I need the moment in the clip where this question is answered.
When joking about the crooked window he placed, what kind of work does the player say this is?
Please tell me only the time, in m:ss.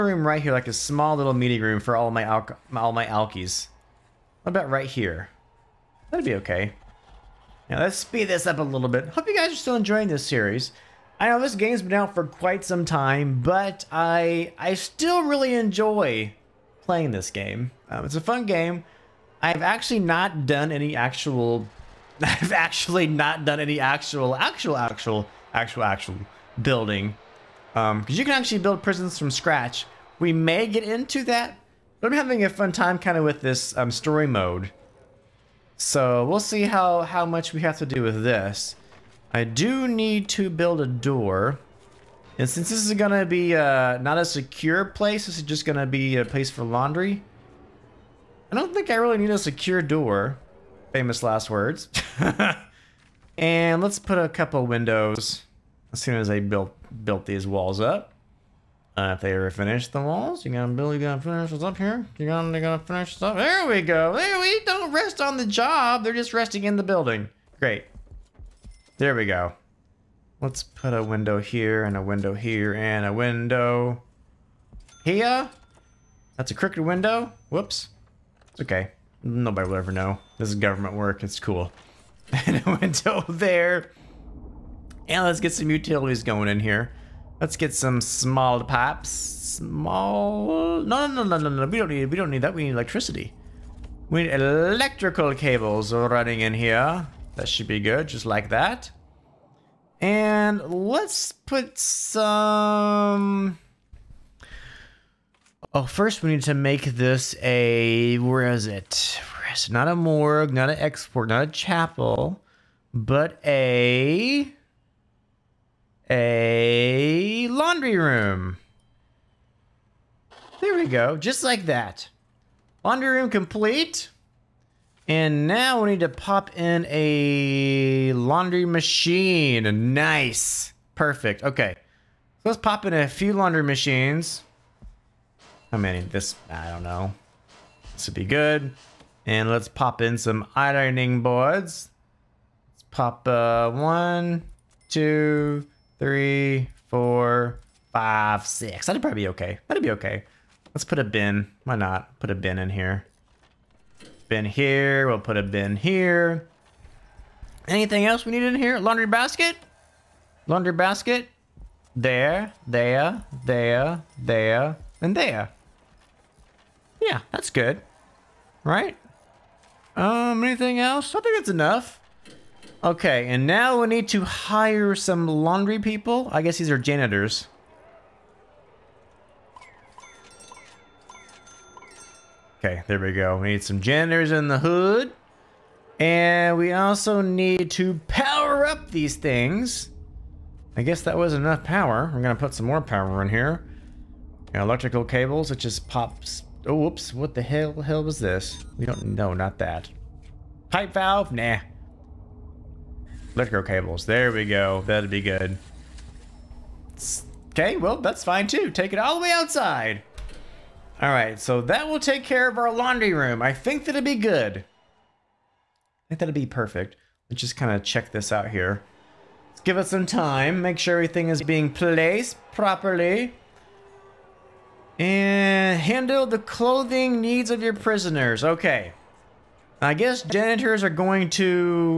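1:20.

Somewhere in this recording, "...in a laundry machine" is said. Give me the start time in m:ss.
2:06.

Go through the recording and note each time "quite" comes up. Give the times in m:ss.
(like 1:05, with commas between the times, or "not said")
0:12.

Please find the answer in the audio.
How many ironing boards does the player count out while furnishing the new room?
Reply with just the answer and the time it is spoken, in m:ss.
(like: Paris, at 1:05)
6, at 2:28.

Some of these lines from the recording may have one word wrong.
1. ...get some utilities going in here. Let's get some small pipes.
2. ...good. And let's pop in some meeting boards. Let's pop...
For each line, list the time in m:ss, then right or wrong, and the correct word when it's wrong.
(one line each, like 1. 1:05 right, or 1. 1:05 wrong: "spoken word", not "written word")
1. 1:25 right
2. 2:18 wrong: "ironing", not "meeting".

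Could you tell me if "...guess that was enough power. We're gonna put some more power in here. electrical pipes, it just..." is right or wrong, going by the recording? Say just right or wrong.
wrong.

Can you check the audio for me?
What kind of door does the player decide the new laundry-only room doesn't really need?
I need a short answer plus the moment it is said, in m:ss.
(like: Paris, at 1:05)
secure door, at 0:49.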